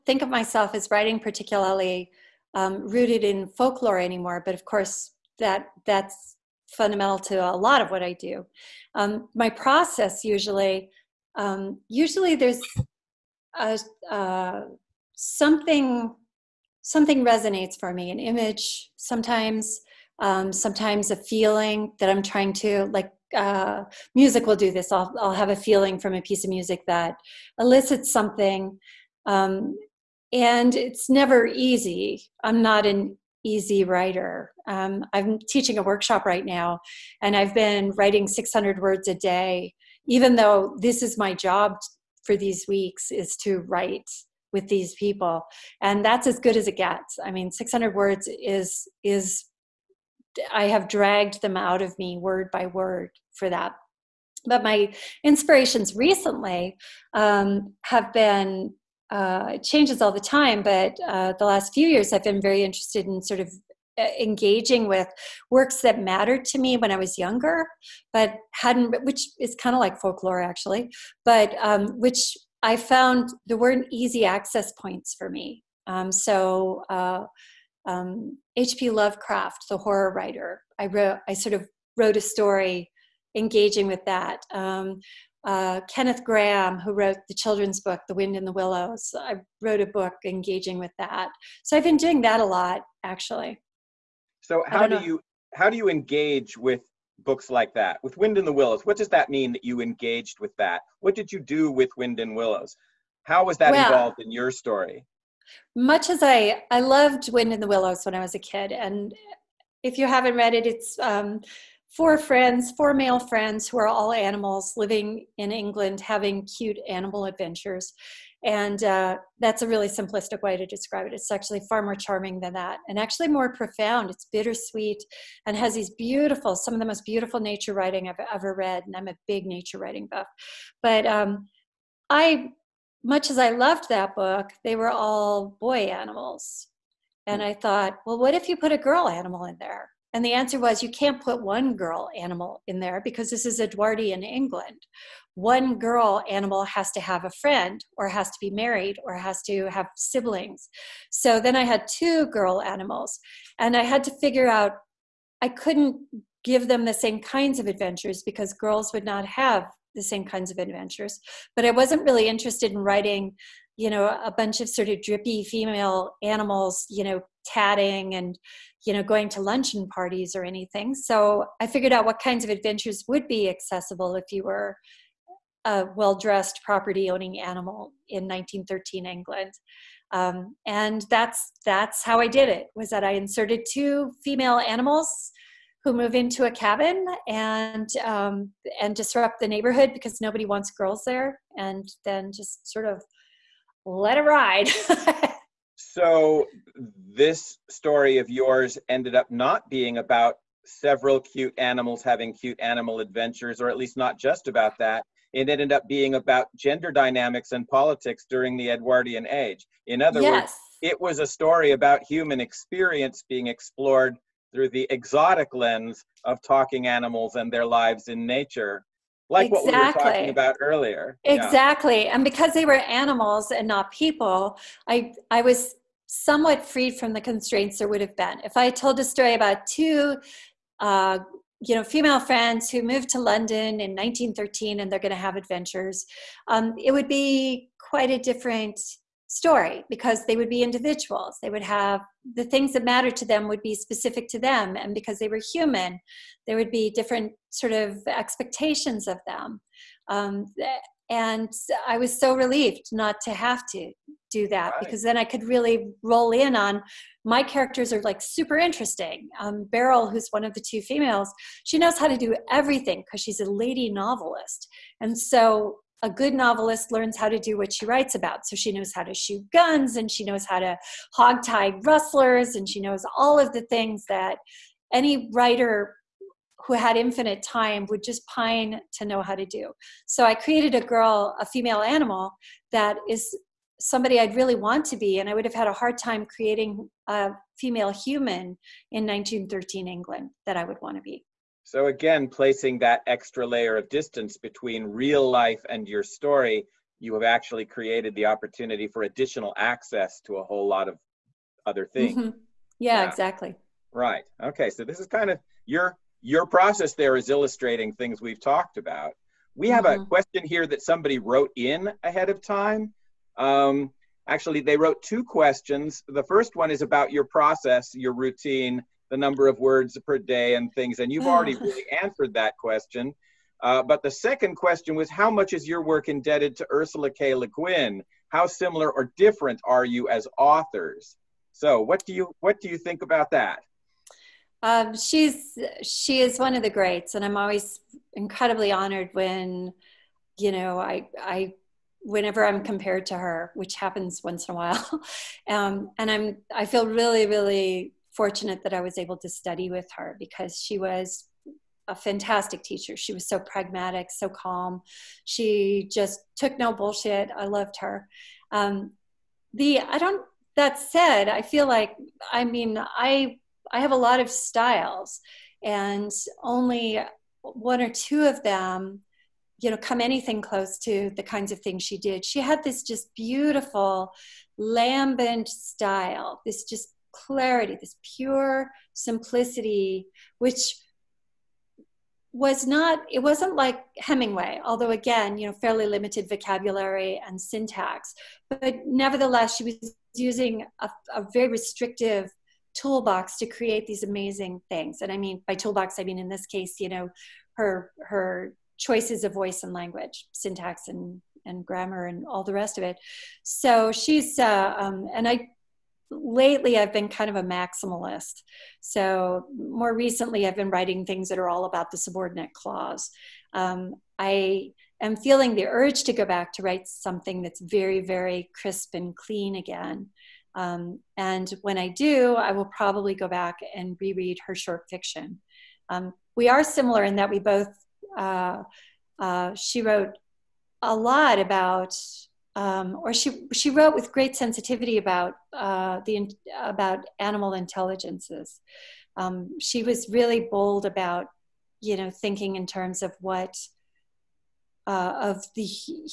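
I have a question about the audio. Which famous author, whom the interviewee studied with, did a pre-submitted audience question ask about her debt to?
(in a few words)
Ursula K. Le Guin.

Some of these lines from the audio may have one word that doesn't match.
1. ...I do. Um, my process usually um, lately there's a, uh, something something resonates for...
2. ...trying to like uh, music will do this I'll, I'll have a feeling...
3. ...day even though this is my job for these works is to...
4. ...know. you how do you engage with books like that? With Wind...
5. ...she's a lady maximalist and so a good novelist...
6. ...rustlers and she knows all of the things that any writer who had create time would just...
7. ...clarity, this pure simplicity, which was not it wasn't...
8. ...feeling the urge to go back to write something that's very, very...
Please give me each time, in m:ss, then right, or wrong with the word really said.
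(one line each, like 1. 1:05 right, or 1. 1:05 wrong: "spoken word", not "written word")
1. 0:08 wrong: "usually", not "lately"
2. 0:22 right
3. 0:39 wrong: "weeks", not "works"
4. 1:34 right
5. 4:23 wrong: "novelist", not "maximalist"
6. 4:31 wrong: "infinite", not "create"
7. 6:17 right
8. 6:55 right.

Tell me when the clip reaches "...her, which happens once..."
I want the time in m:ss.
5:43.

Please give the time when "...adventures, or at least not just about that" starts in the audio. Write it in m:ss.
3:22.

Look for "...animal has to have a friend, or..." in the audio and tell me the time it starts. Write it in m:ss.
2:26.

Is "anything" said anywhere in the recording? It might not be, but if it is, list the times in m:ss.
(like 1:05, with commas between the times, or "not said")
2:50, 6:10.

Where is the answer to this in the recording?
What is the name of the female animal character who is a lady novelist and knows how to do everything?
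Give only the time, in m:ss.
4:19.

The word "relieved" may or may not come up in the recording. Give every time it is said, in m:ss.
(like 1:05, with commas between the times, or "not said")
4:12.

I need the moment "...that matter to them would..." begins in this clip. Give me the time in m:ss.
4:02.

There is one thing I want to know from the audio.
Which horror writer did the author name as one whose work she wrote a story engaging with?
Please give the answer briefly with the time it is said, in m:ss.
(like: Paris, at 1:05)
H.P. Lovecraft, at 1:18.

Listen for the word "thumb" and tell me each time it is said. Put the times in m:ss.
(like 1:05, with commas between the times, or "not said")
not said.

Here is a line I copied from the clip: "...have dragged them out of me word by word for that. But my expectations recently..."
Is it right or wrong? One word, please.
wrong.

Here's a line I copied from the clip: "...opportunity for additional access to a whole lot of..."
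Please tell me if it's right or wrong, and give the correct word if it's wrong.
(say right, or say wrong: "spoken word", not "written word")
right.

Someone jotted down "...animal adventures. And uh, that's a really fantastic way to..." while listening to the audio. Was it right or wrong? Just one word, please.
wrong.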